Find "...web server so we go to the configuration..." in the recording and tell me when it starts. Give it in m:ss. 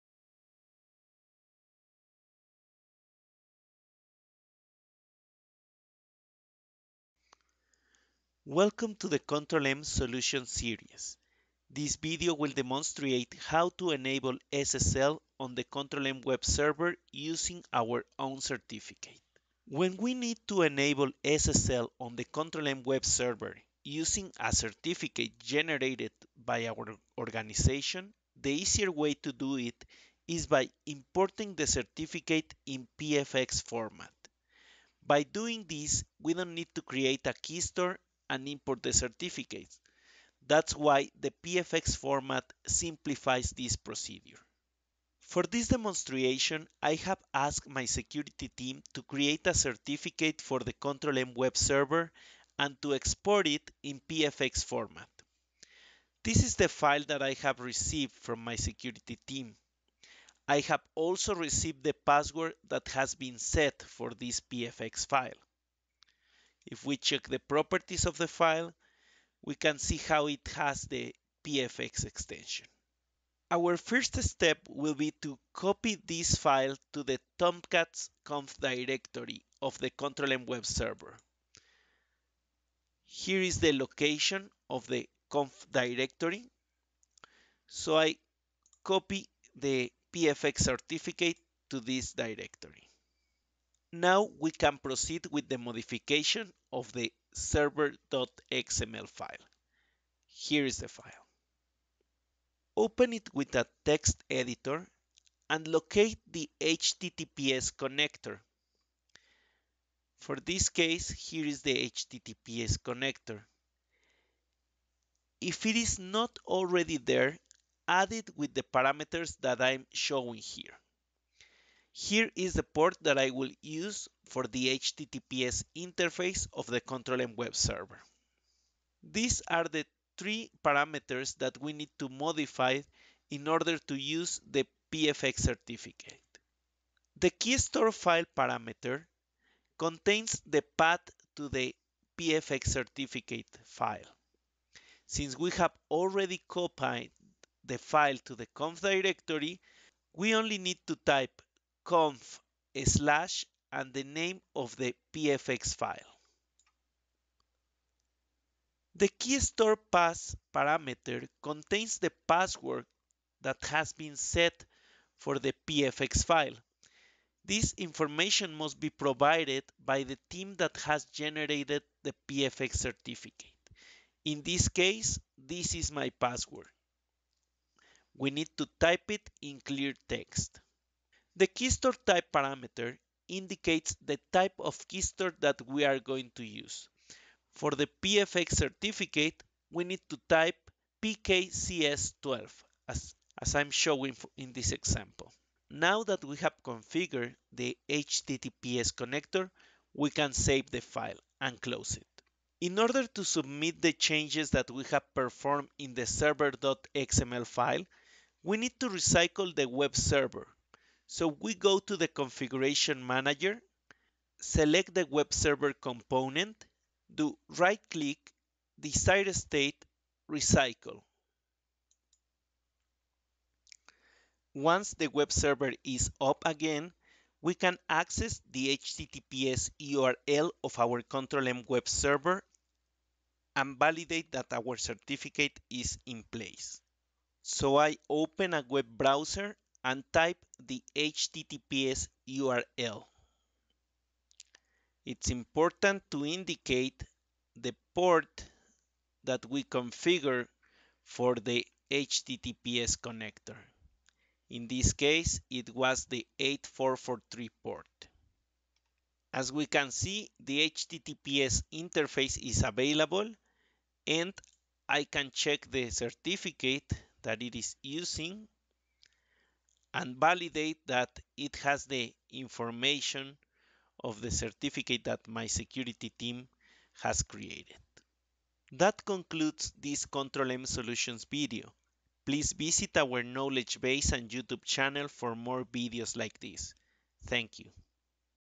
3:29.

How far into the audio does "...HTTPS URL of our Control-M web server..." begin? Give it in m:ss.
3:48.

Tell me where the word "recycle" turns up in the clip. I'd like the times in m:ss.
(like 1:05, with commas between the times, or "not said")
3:28, 3:40.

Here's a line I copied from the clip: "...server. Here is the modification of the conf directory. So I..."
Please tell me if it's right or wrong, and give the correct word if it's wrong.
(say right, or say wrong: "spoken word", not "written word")
wrong: "location", not "modification".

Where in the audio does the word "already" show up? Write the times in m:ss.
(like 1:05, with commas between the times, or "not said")
1:56, 2:25.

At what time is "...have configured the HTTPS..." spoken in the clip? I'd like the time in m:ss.
3:16.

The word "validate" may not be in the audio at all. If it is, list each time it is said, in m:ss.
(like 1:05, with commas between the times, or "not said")
3:53, 4:30.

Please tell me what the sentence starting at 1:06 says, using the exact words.
If we check the properties of the file, we can see how it has the PFX extension.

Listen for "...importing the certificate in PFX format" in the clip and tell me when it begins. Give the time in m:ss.
0:30.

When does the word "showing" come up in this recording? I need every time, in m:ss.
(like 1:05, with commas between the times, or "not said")
1:59, 3:13.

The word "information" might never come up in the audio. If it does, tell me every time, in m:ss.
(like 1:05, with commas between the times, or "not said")
2:47, 4:32.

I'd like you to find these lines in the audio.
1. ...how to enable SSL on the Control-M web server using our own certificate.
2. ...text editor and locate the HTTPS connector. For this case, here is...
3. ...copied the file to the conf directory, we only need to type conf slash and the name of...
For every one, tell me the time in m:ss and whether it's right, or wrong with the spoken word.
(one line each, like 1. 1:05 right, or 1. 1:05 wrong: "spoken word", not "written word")
1. 0:13 right
2. 1:43 right
3. 2:26 right.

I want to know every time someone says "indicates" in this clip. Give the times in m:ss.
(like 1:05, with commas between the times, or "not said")
3:03, 4:06.